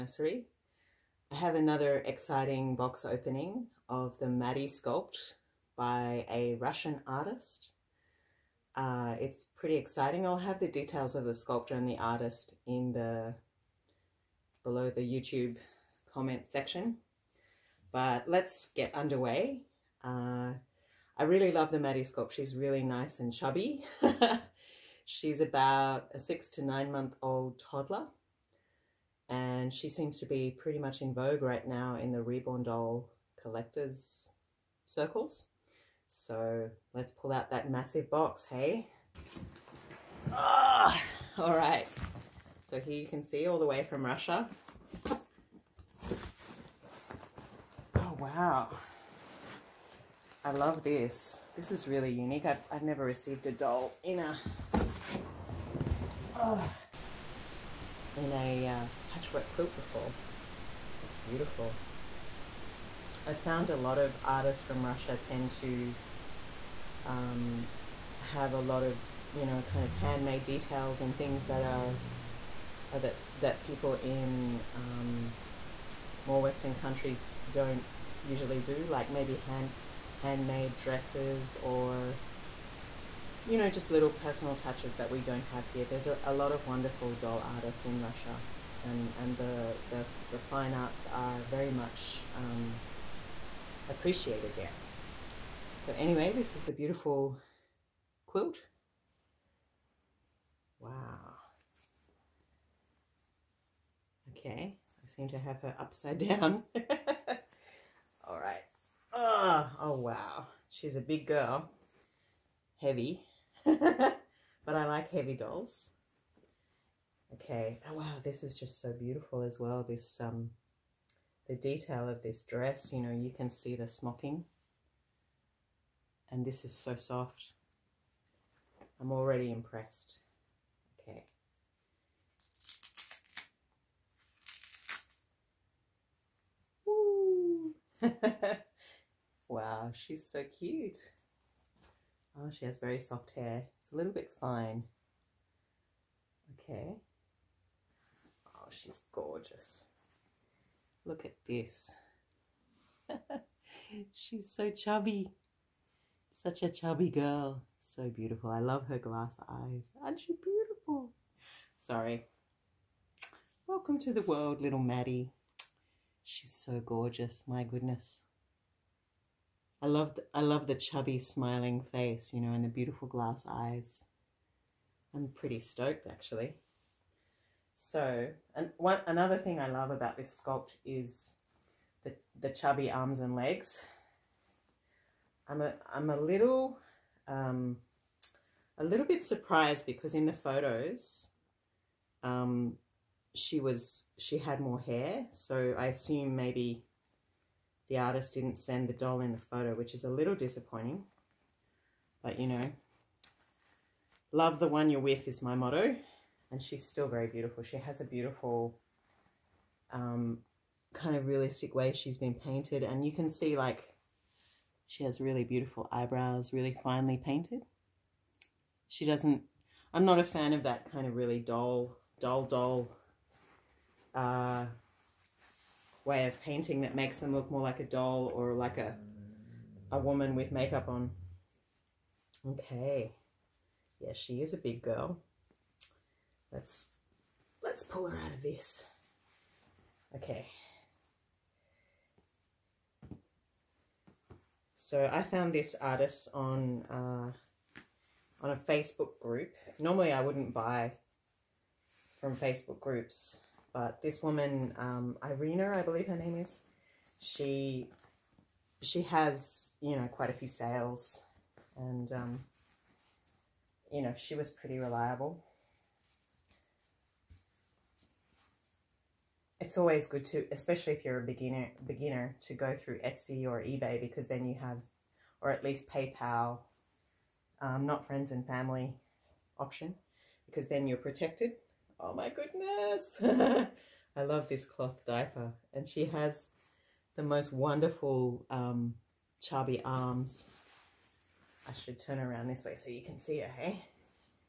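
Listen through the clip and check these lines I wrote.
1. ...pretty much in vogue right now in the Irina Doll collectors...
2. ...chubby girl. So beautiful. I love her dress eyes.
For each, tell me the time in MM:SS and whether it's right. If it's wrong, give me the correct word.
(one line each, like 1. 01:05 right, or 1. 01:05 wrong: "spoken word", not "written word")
1. 00:30 wrong: "Reborn", not "Irina"
2. 02:36 wrong: "glass", not "dress".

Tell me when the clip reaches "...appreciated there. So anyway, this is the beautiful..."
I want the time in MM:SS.
01:33.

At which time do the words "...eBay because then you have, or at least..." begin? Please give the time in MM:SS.
04:33.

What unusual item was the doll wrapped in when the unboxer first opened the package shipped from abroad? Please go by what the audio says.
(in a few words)
patchwork quilt.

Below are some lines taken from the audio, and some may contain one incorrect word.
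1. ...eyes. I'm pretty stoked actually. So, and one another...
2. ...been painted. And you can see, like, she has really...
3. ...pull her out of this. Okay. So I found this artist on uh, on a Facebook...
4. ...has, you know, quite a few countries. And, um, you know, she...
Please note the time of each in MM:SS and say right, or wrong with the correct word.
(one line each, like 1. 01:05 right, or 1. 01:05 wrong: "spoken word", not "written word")
1. 02:53 right
2. 03:32 right
3. 03:57 right
4. 04:19 wrong: "sales", not "countries".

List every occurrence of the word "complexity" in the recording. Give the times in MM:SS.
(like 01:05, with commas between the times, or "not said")
not said.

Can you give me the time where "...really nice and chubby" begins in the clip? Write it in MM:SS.
00:22.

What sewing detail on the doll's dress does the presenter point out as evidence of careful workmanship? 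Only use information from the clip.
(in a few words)
smocking.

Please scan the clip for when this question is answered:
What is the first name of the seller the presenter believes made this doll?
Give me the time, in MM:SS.
04:15.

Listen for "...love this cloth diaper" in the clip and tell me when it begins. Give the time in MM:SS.
04:44.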